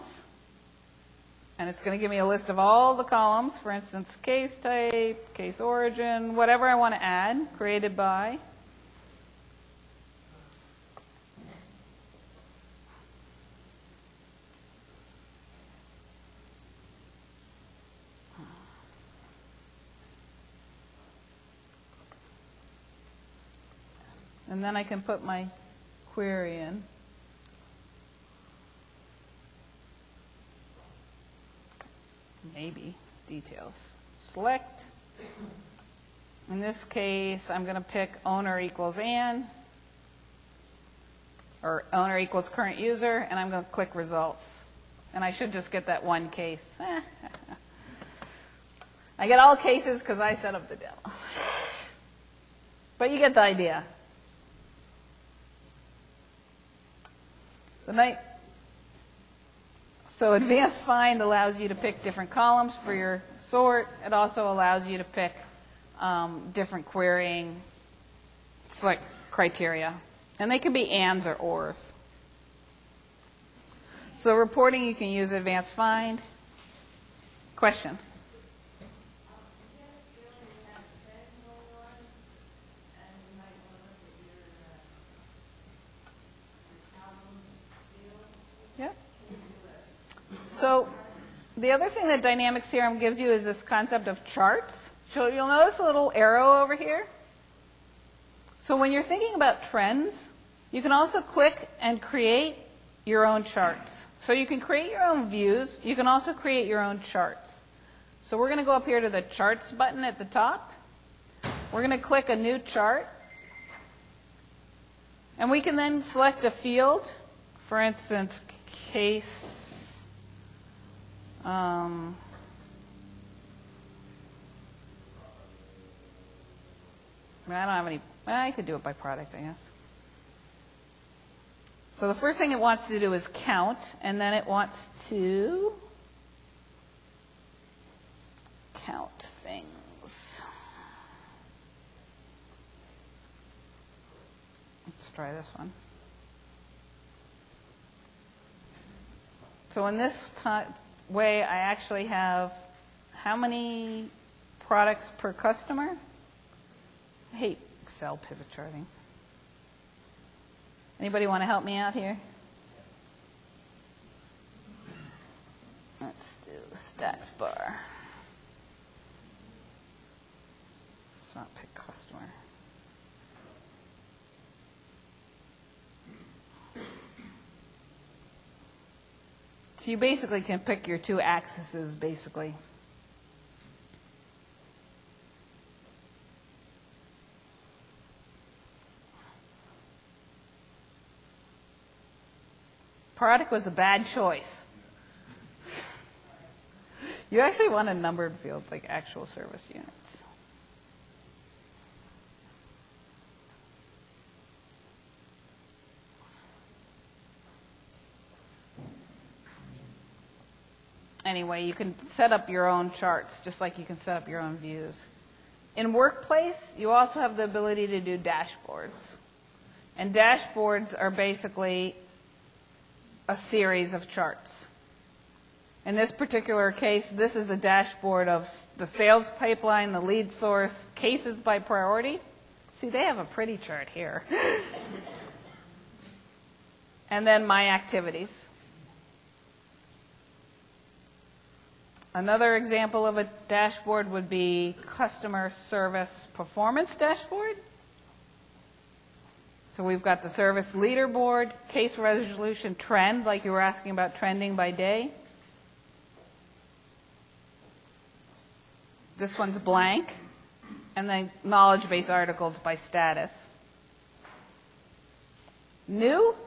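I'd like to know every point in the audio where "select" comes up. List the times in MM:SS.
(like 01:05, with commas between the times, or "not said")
00:34, 01:08, 01:56.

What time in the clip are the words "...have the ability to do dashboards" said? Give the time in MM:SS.
03:37.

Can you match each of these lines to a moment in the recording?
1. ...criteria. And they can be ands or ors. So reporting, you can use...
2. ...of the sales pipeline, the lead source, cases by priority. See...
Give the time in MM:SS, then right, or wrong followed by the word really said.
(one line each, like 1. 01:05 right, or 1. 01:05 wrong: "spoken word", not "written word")
1. 01:09 right
2. 03:48 right.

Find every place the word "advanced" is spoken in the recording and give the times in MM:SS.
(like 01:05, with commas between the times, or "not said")
01:00, 01:15.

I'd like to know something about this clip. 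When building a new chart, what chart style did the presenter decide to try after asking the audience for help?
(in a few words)
Stacked bar.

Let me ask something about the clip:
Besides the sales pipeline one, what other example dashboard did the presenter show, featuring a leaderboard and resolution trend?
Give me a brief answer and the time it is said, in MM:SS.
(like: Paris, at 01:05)
Customer service performance dashboard, at 04:04.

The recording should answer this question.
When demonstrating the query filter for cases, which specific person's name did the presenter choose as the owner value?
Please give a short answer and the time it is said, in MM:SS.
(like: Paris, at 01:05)
Anne, at 00:38.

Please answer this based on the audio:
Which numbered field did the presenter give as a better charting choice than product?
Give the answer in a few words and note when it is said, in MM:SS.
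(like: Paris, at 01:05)
Actual service units, at 03:18.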